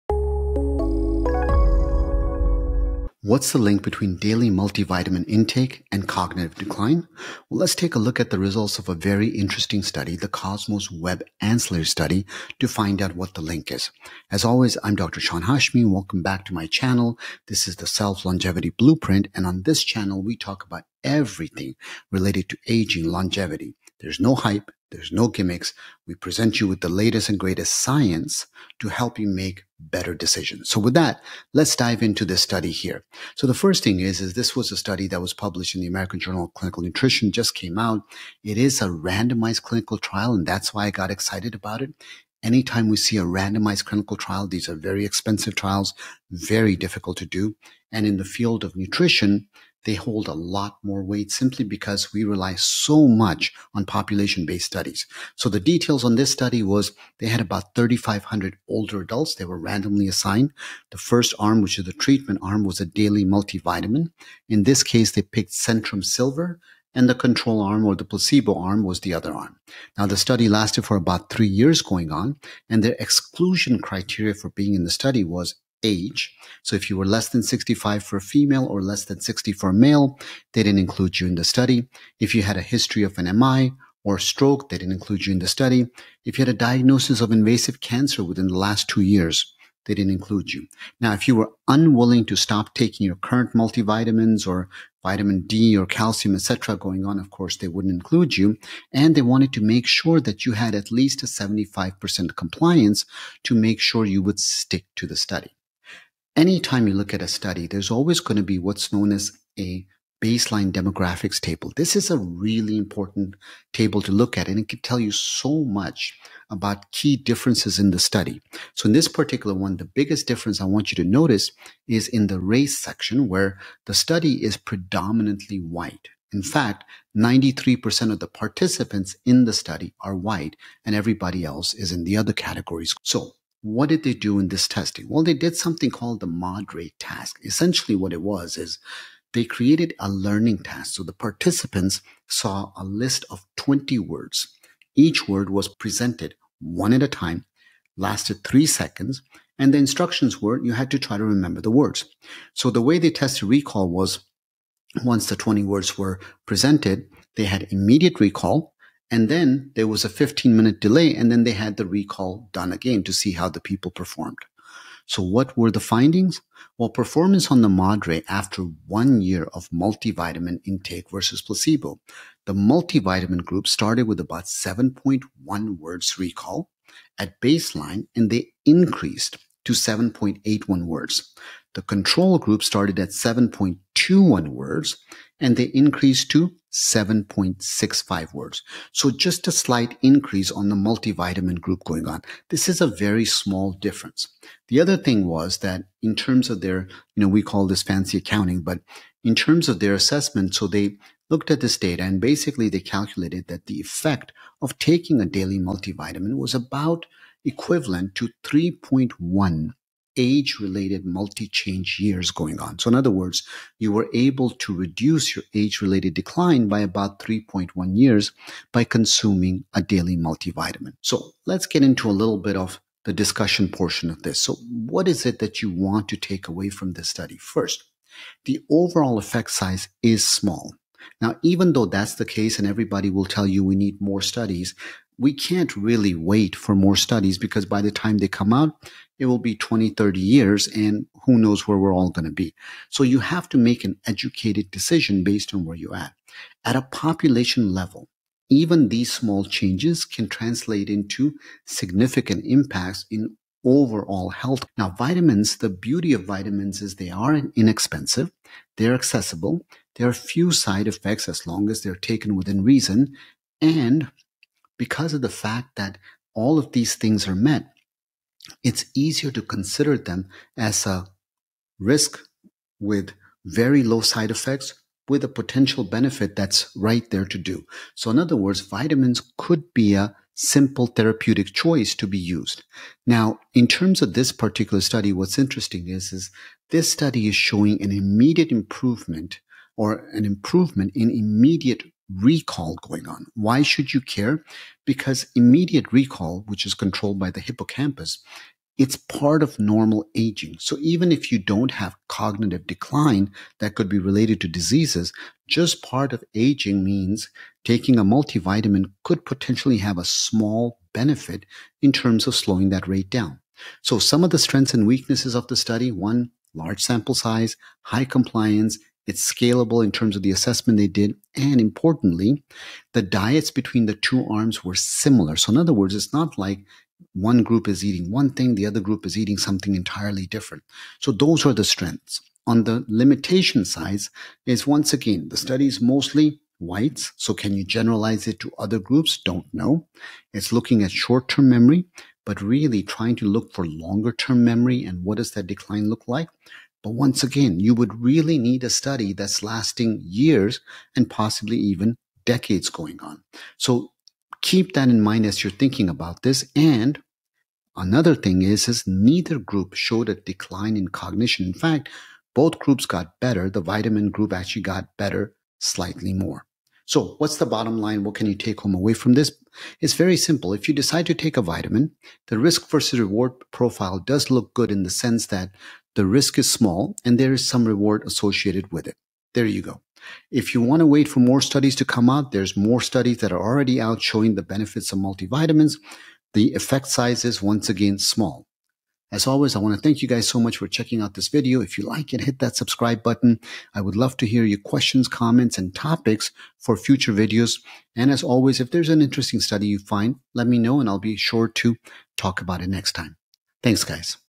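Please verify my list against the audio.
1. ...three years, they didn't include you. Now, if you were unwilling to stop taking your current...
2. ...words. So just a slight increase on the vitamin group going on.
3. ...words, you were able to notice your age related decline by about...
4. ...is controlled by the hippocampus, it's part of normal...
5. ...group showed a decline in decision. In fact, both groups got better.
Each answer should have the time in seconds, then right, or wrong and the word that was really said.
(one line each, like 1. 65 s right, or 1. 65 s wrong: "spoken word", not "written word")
1. 88 s wrong: "two", not "three"
2. 188 s wrong: "multivitamin", not "vitamin"
3. 213 s wrong: "reduce", not "notice"
4. 296 s right
5. 359 s wrong: "cognition", not "decision".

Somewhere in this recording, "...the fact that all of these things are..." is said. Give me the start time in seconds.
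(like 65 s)
265 s.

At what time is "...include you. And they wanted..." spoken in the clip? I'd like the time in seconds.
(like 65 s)
97 s.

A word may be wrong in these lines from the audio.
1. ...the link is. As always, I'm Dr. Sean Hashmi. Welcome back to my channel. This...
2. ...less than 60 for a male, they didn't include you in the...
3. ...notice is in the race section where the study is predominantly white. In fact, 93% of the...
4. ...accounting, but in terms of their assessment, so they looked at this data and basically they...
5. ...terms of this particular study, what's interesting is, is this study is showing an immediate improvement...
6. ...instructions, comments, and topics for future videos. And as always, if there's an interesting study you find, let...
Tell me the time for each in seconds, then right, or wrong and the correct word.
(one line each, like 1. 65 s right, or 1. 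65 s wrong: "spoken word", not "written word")
1. 13 s right
2. 78 s right
3. 121 s right
4. 198 s right
5. 283 s right
6. 394 s wrong: "questions", not "instructions".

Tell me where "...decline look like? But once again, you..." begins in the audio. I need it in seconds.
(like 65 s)
345 s.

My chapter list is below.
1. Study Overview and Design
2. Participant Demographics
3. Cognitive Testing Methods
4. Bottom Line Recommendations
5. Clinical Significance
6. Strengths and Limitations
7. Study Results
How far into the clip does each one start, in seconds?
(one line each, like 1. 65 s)
1. 33 s
2. 99 s
3. 133 s
4. 354 s
5. 222 s
6. 281 s
7. 167 s.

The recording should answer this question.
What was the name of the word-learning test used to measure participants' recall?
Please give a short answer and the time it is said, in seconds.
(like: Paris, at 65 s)
ModRey task, at 136 s.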